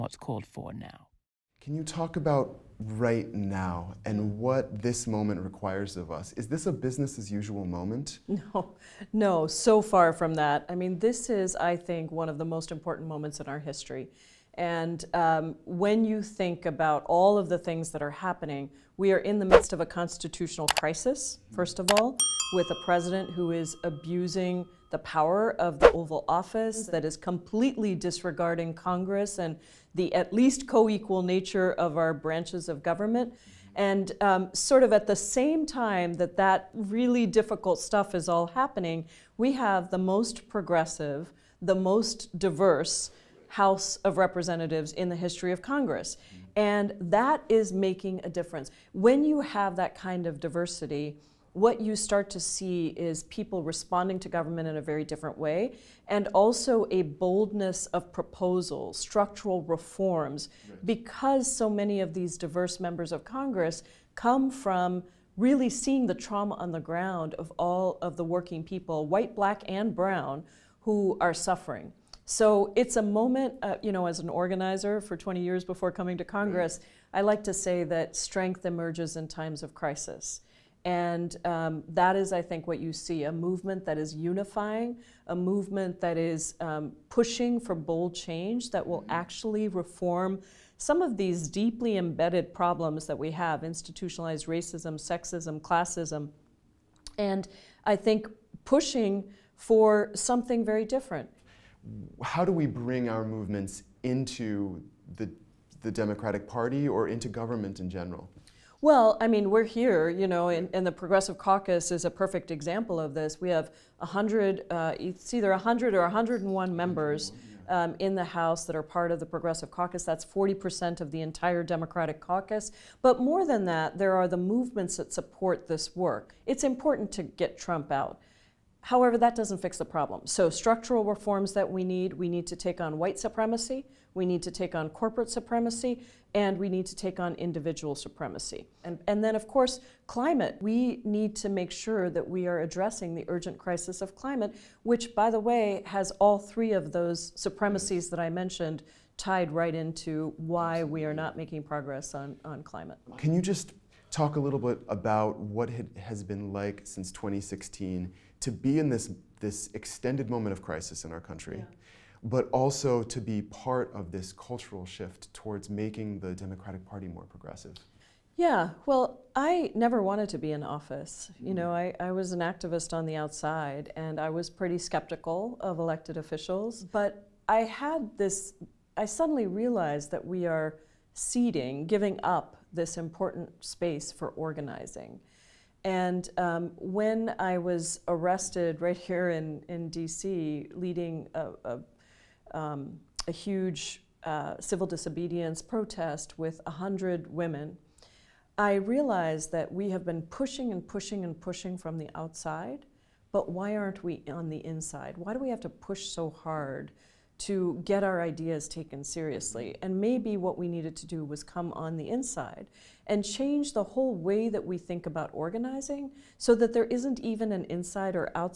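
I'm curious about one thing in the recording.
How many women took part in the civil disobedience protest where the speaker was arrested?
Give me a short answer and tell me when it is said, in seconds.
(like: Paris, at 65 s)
100, at 196 s.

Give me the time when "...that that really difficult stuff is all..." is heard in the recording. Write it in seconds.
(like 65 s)
36 s.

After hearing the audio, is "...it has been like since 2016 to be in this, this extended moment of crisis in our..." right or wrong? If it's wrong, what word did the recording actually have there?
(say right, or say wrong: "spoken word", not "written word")
right.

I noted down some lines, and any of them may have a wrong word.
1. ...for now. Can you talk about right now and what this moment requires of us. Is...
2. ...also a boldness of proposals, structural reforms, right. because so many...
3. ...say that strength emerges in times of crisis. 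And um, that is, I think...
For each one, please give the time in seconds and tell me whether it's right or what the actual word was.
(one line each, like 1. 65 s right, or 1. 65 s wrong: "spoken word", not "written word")
1. 0 s right
2. 56 s right
3. 77 s right.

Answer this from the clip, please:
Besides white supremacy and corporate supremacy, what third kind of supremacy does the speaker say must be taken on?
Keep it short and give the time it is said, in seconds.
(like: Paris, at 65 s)
individual supremacy, at 137 s.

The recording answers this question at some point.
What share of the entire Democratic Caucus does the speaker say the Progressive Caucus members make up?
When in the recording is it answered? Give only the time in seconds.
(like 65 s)
120 s.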